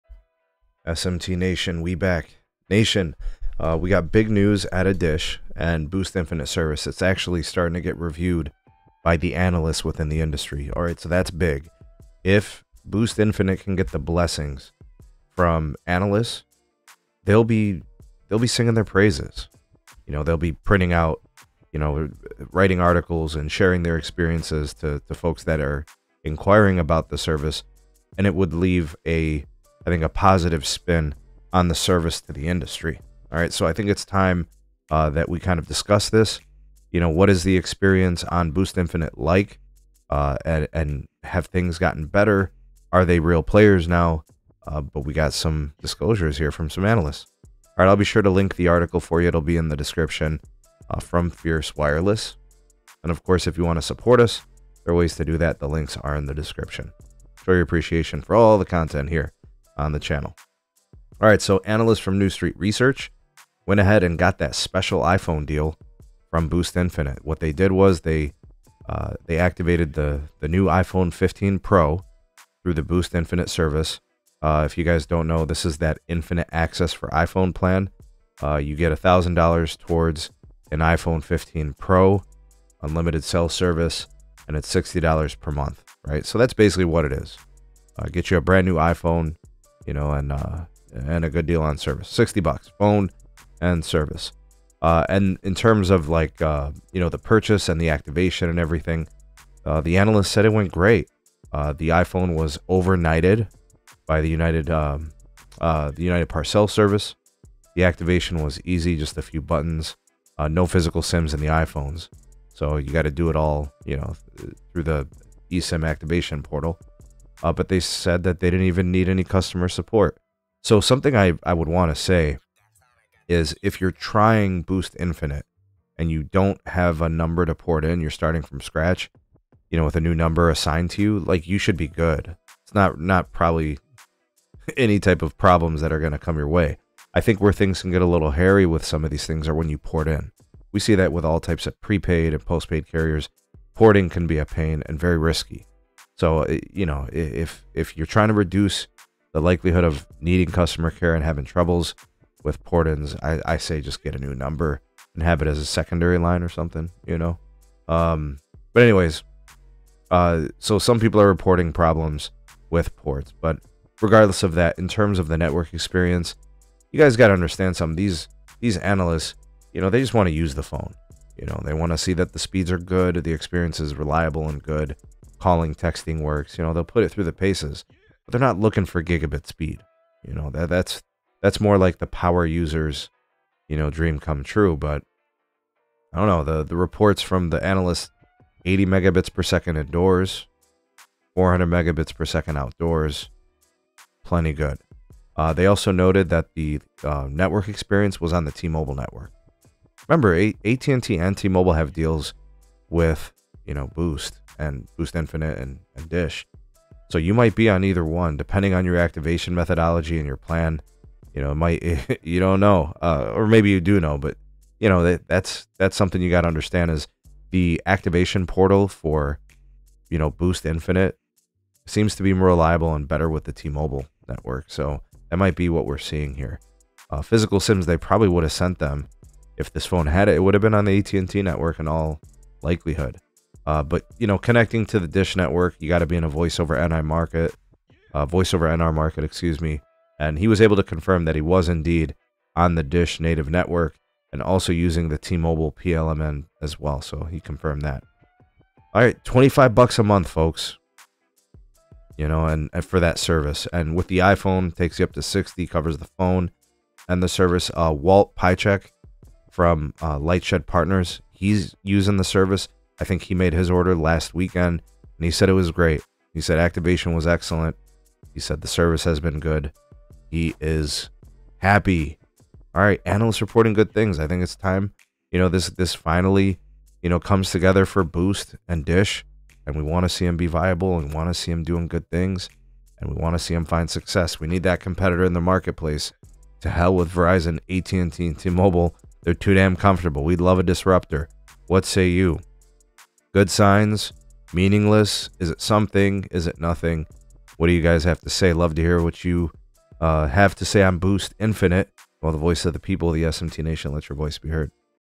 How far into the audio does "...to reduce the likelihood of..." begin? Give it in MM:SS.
02:28.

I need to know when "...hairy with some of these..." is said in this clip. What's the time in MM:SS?
02:18.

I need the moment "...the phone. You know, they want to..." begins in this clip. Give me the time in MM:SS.
02:50.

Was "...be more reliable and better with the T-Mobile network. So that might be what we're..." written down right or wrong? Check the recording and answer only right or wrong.
right.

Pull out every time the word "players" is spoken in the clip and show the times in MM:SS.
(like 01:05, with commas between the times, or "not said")
00:43.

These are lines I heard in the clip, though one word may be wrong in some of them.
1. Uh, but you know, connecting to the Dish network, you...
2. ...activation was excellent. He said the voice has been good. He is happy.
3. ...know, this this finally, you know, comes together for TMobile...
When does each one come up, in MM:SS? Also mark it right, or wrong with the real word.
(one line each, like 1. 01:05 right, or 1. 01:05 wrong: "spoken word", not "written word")
1. 03:53 right
2. 04:26 wrong: "service", not "voice"
3. 04:35 wrong: "Boost", not "TMobile".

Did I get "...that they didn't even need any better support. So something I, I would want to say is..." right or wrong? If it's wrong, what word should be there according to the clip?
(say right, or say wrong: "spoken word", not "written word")
wrong: "customer", not "better".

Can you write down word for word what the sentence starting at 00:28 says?
And it would leave a I think, a positive spin on the service to the industry.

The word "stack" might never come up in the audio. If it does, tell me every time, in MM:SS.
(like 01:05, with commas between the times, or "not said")
not said.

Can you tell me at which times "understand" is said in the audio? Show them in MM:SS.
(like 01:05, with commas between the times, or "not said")
02:47, 03:36.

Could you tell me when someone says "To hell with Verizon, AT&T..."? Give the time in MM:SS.
04:46.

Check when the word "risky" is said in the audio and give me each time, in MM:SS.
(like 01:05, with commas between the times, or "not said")
02:25.